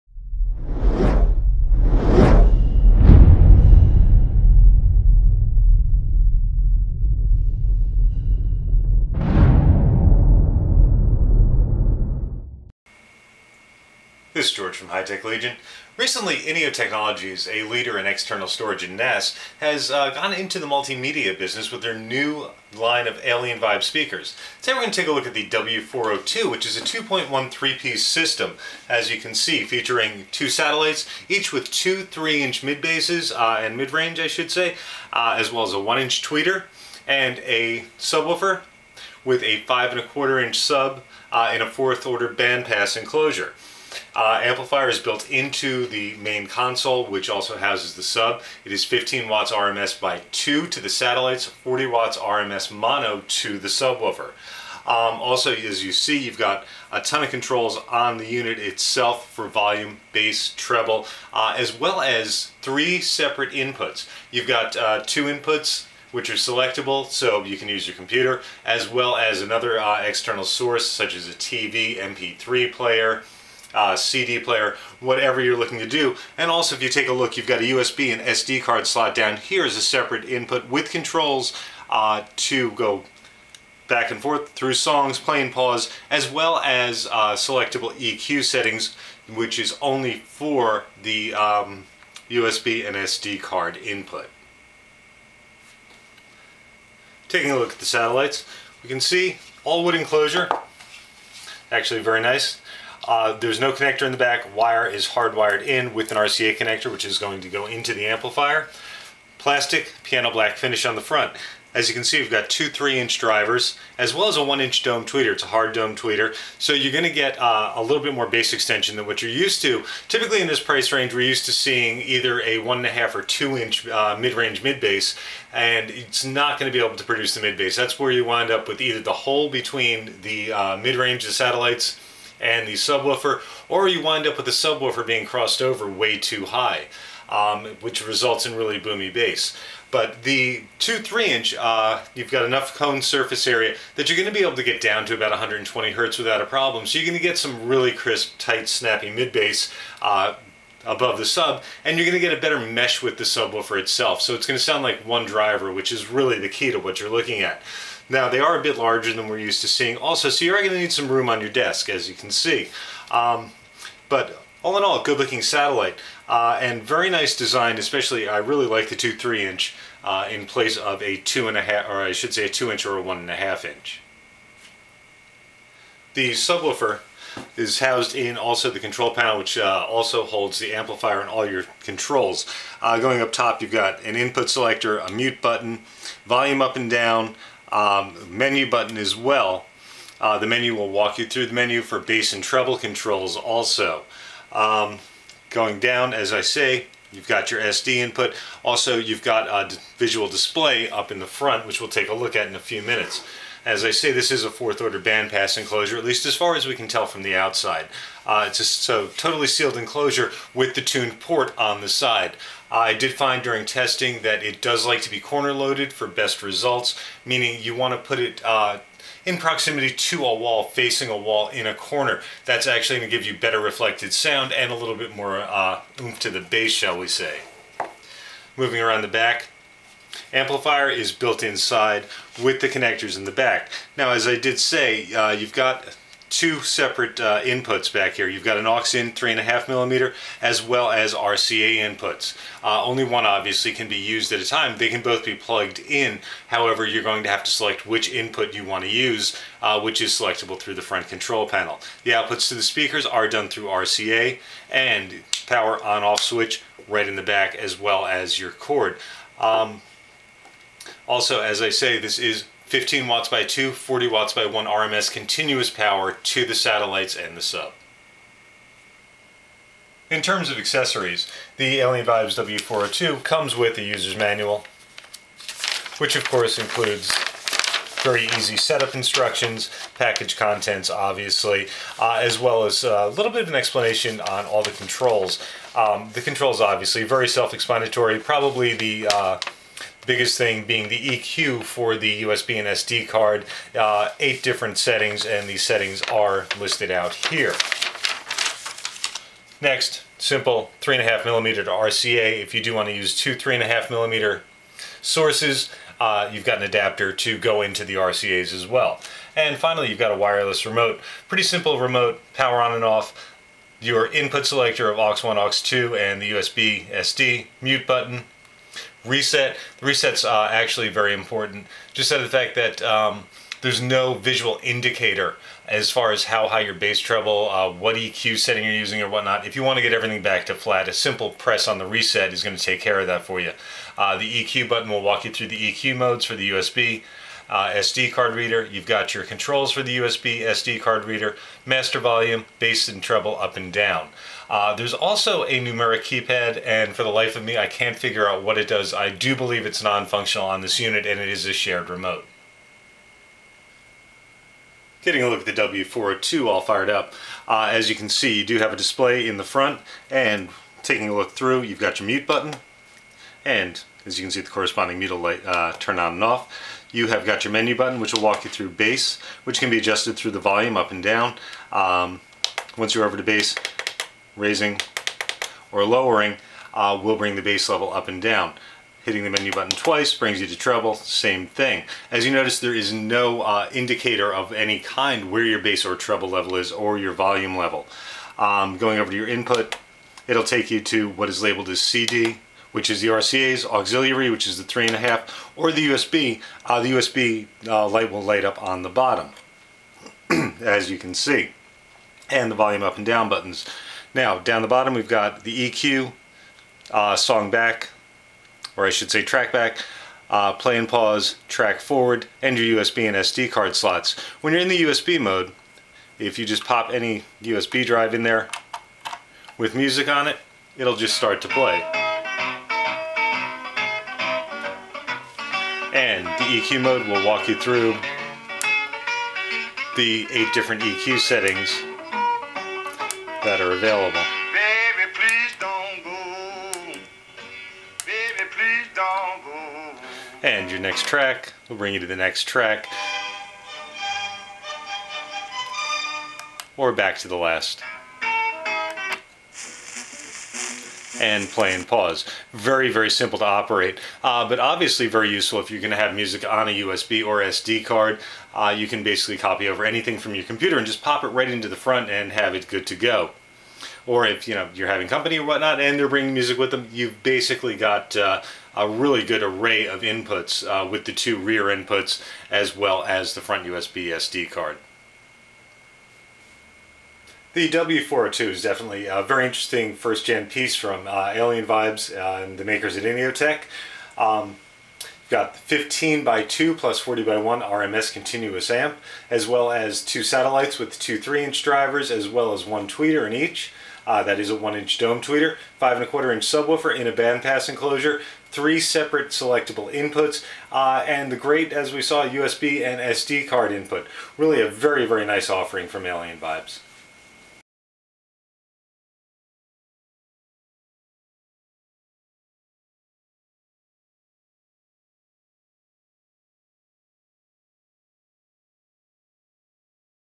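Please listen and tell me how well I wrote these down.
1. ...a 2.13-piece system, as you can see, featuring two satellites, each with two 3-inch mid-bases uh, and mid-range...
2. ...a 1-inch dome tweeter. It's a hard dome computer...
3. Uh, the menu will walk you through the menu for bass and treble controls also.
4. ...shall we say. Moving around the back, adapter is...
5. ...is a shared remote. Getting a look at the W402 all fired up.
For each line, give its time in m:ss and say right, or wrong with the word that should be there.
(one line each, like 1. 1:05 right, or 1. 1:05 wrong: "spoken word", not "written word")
1. 0:26 right
2. 1:54 wrong: "tweeter", not "computer"
3. 3:10 right
4. 3:46 wrong: "amplifier", not "adapter"
5. 5:51 right.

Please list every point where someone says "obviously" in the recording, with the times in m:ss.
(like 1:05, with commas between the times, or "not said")
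4:03, 4:40, 4:46, 7:34.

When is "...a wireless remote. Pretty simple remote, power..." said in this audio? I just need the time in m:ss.
5:10.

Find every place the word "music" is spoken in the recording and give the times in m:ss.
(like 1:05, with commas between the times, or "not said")
6:59, 7:36, 7:46.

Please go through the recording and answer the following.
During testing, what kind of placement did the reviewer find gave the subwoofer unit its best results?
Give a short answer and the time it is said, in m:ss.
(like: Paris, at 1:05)
corner loaded, at 3:35.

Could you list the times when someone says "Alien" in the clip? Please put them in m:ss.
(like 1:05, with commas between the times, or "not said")
0:23, 4:31, 8:01, 8:26.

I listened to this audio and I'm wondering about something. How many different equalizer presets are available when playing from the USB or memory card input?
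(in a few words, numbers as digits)
8.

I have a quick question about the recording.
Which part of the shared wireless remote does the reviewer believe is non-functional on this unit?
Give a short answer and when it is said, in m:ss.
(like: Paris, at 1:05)
numeric keypad, at 5:45.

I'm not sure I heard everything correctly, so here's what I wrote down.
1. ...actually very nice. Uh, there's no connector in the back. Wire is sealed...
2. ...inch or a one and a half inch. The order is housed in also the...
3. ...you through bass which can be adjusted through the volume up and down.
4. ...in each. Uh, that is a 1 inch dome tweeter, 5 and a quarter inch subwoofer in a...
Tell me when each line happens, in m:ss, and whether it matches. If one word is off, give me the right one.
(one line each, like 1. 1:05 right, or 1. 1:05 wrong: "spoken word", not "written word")
1. 1:41 wrong: "hardwired", not "sealed"
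2. 2:52 wrong: "subwoofer", not "order"
3. 6:08 right
4. 8:13 right.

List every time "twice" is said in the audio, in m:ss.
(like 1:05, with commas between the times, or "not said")
6:19.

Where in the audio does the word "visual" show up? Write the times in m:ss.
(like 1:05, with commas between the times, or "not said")
3:19, 5:24.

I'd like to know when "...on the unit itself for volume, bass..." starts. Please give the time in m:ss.
0:57.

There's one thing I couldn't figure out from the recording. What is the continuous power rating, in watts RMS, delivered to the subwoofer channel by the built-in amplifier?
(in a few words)
40 watts.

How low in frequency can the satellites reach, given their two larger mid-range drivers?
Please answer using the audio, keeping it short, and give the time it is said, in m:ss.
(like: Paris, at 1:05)
120 hertz, at 2:25.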